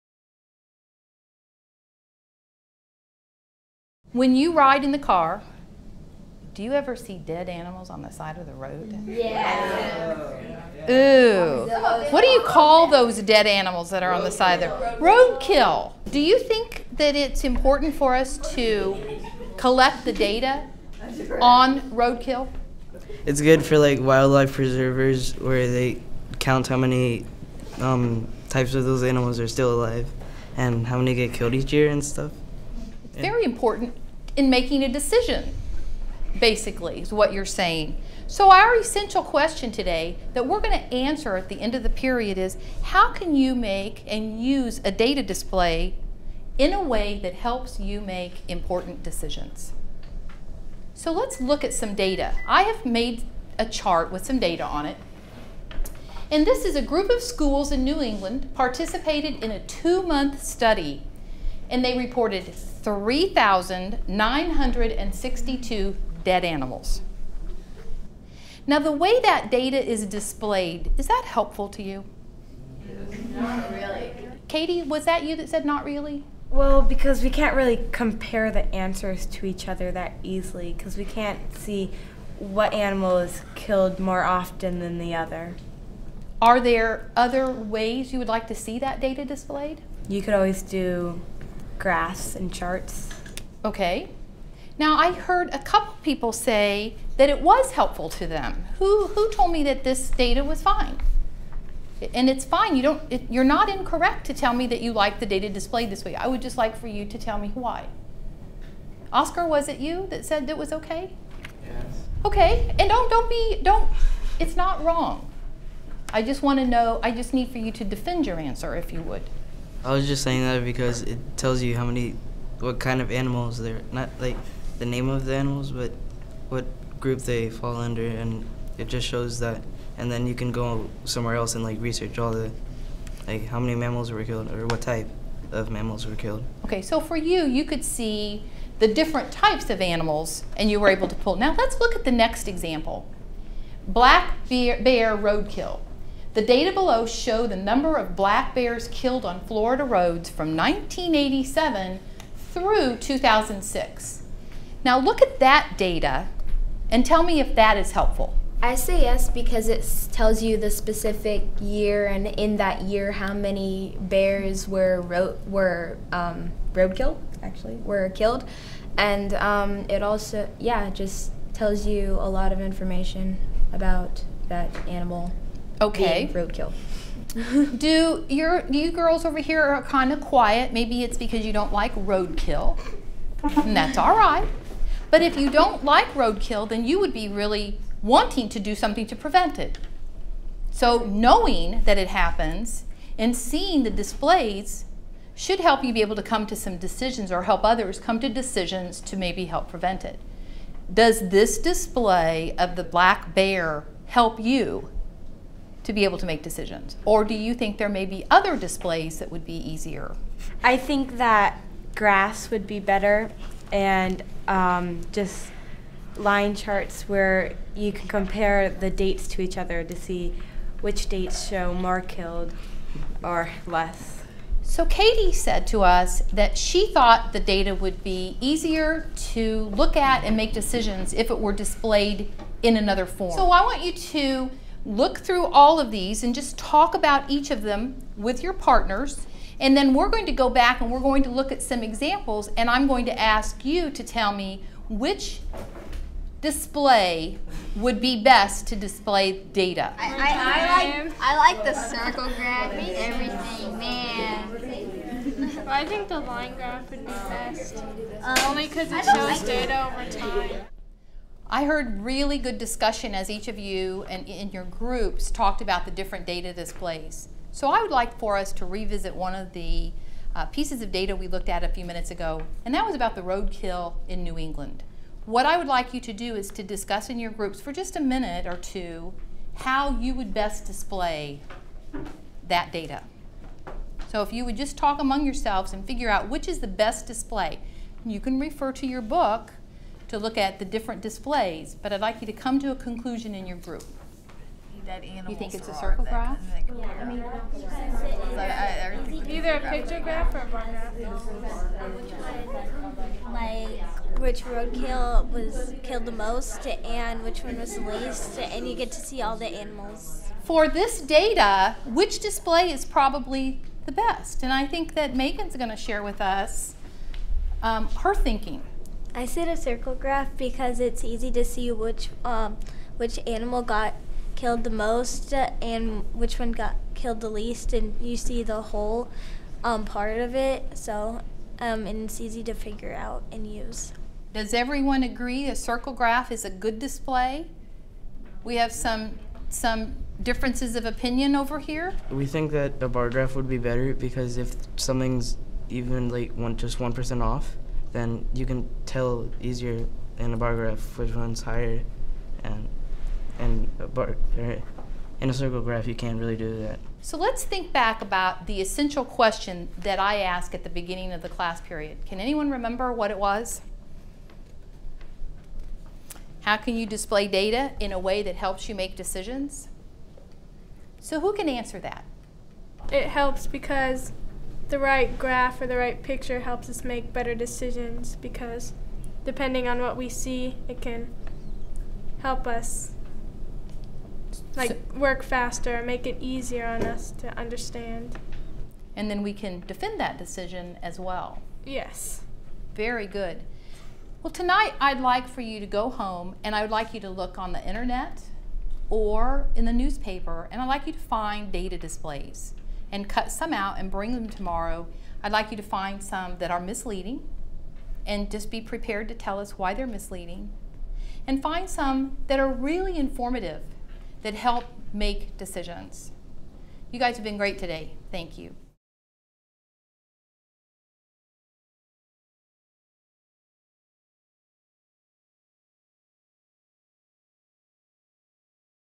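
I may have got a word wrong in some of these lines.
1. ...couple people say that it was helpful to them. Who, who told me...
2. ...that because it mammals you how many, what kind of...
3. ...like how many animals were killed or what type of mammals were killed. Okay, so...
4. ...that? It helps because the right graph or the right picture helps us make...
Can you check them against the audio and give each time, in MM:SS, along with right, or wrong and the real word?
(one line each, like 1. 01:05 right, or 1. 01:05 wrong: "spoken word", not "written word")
1. 01:35 right
2. 02:00 wrong: "tells", not "mammals"
3. 02:13 wrong: "mammals", not "animals"
4. 06:11 right.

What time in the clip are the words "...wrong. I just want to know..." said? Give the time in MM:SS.
01:54.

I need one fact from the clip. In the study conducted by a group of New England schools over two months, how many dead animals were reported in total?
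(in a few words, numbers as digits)
3,962.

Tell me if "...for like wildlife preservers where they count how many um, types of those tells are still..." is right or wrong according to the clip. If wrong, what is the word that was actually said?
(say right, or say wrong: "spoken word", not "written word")
wrong: "animals", not "tells".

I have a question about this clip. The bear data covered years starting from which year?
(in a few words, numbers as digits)
1987.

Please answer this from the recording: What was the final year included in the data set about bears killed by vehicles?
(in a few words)
2006.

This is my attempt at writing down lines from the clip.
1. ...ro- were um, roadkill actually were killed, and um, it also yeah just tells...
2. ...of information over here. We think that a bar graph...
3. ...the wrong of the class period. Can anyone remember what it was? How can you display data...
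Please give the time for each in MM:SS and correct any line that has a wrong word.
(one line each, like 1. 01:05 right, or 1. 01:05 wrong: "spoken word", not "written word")
1. 02:45 right
2. 05:40 wrong: "opinion", not "information"
3. 06:00 wrong: "beginning", not "wrong".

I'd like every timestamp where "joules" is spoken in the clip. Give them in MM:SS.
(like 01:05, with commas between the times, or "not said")
not said.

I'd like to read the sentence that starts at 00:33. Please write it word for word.
It's very important in making a decision, basically, is what you're saying.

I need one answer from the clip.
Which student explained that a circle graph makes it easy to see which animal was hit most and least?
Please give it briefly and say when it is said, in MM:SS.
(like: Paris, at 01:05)
Megan, at 05:15.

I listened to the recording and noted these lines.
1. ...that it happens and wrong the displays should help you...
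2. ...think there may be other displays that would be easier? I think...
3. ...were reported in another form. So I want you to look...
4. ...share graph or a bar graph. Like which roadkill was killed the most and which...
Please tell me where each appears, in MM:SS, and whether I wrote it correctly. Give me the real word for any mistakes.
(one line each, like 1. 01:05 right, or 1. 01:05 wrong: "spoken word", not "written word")
1. 03:11 wrong: "seeing", not "wrong"
2. 03:27 right
3. 03:51 wrong: "displayed", not "reported"
4. 04:59 wrong: "picture", not "share".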